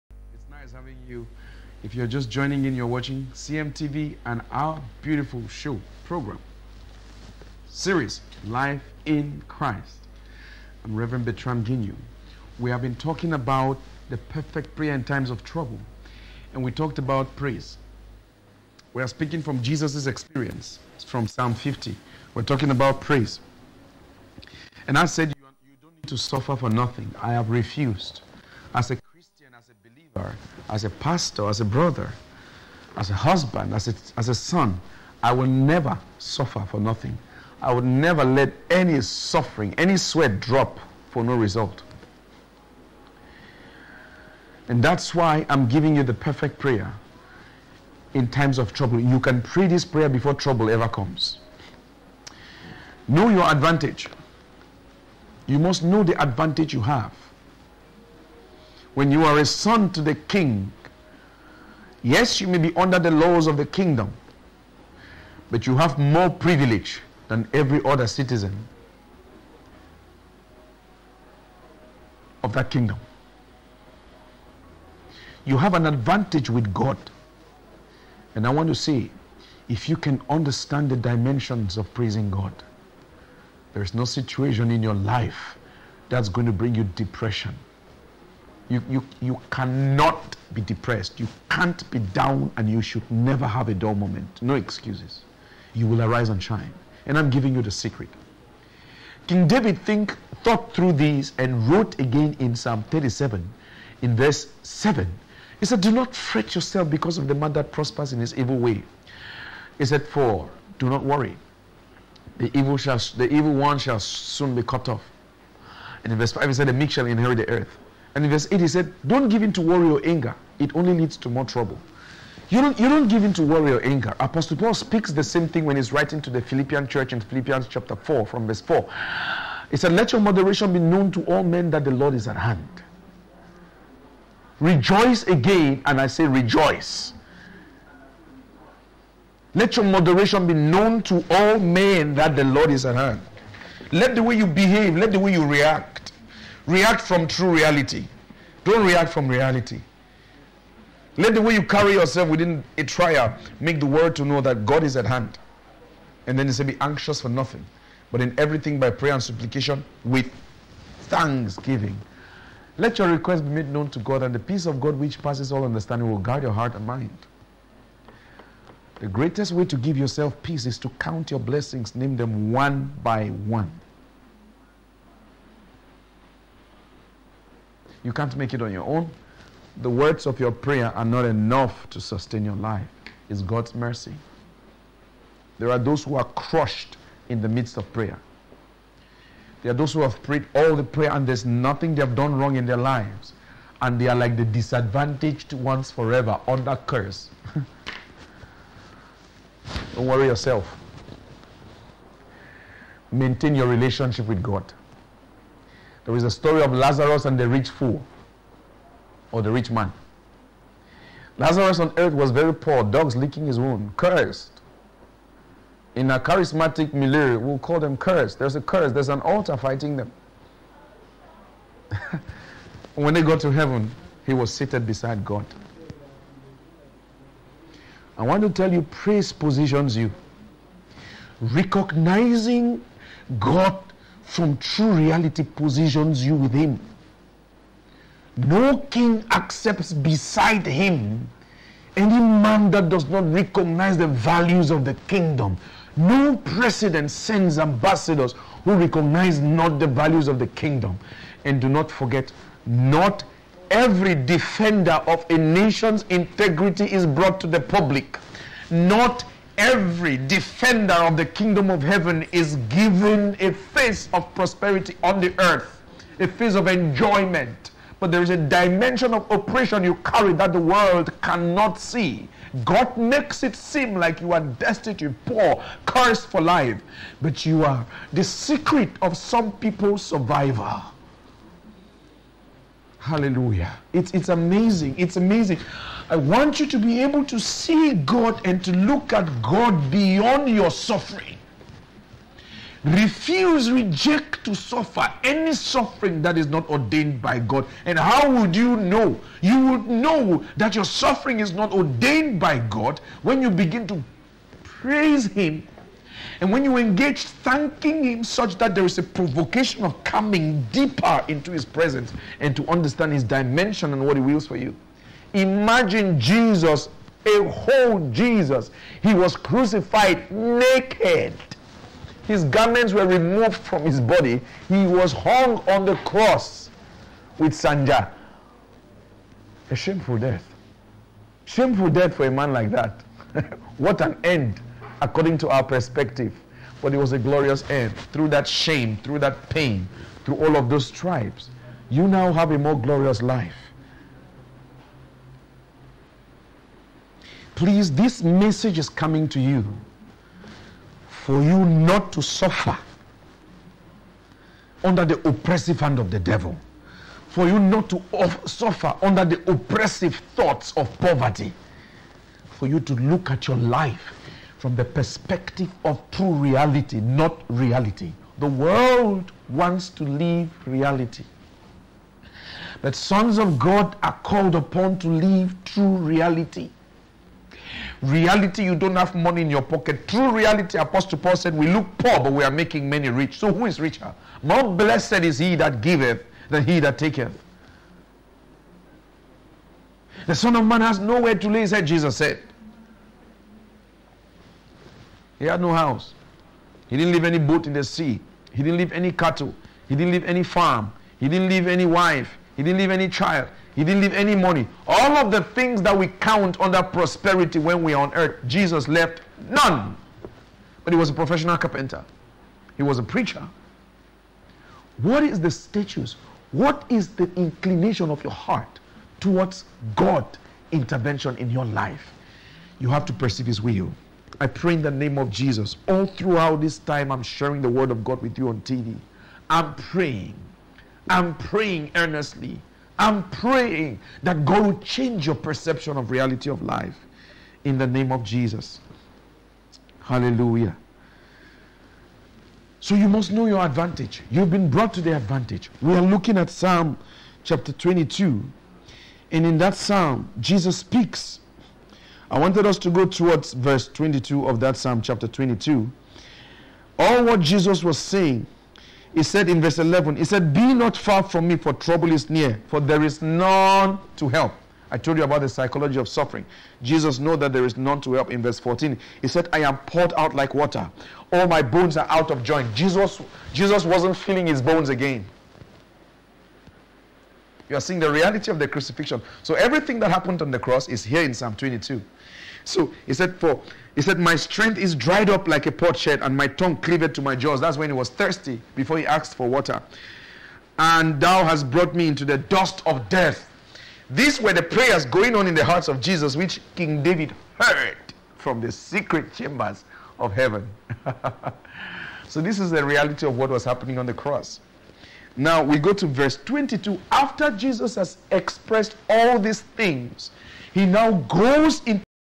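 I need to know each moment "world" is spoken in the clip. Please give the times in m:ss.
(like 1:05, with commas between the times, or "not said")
2:33, 4:30, 6:08.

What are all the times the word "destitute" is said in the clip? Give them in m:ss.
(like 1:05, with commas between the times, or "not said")
4:34.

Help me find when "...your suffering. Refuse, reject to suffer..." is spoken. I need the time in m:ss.
4:50.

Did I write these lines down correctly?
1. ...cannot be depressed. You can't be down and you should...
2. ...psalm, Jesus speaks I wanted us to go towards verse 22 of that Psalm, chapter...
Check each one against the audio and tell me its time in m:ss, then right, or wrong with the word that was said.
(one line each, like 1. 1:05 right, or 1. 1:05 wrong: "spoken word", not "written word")
1. 1:29 right
2. 7:29 right.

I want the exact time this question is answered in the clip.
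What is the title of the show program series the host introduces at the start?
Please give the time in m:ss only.
0:08.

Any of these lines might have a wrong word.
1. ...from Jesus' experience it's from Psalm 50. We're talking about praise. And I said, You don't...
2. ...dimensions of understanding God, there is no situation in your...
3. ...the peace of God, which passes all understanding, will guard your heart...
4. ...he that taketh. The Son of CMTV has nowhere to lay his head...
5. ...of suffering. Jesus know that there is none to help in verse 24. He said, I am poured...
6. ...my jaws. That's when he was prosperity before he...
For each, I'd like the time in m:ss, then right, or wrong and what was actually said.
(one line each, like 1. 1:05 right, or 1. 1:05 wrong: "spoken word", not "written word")
1. 0:19 right
2. 1:20 wrong: "praising", not "understanding"
3. 2:44 right
4. 6:26 wrong: "Man", not "CMTV"
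5. 7:45 wrong: "14", not "24"
6. 8:07 wrong: "thirsty", not "prosperity".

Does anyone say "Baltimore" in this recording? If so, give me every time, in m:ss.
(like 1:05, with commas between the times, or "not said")
not said.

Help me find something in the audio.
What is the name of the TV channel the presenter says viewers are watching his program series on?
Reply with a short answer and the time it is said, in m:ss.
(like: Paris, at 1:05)
CMTV, at 0:03.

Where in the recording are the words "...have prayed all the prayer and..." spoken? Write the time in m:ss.
3:10.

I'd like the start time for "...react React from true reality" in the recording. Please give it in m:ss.
2:25.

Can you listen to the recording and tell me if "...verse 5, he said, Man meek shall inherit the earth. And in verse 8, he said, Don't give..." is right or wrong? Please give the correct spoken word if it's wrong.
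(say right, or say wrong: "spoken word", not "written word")
wrong: "The", not "Man".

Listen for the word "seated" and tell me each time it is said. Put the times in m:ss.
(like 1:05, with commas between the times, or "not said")
3:44.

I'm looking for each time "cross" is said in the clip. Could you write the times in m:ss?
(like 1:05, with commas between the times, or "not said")
5:26, 8:00, 8:24.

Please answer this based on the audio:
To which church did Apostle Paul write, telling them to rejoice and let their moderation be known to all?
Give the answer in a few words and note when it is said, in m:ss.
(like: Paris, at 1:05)
Philippian church, at 2:06.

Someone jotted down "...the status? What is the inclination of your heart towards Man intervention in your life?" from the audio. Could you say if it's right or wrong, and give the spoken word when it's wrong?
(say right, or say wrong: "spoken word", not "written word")
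wrong: "God", not "Man".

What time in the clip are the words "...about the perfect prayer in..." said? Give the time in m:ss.
0:13.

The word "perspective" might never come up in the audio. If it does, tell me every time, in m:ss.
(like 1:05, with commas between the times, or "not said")
5:35, 6:04.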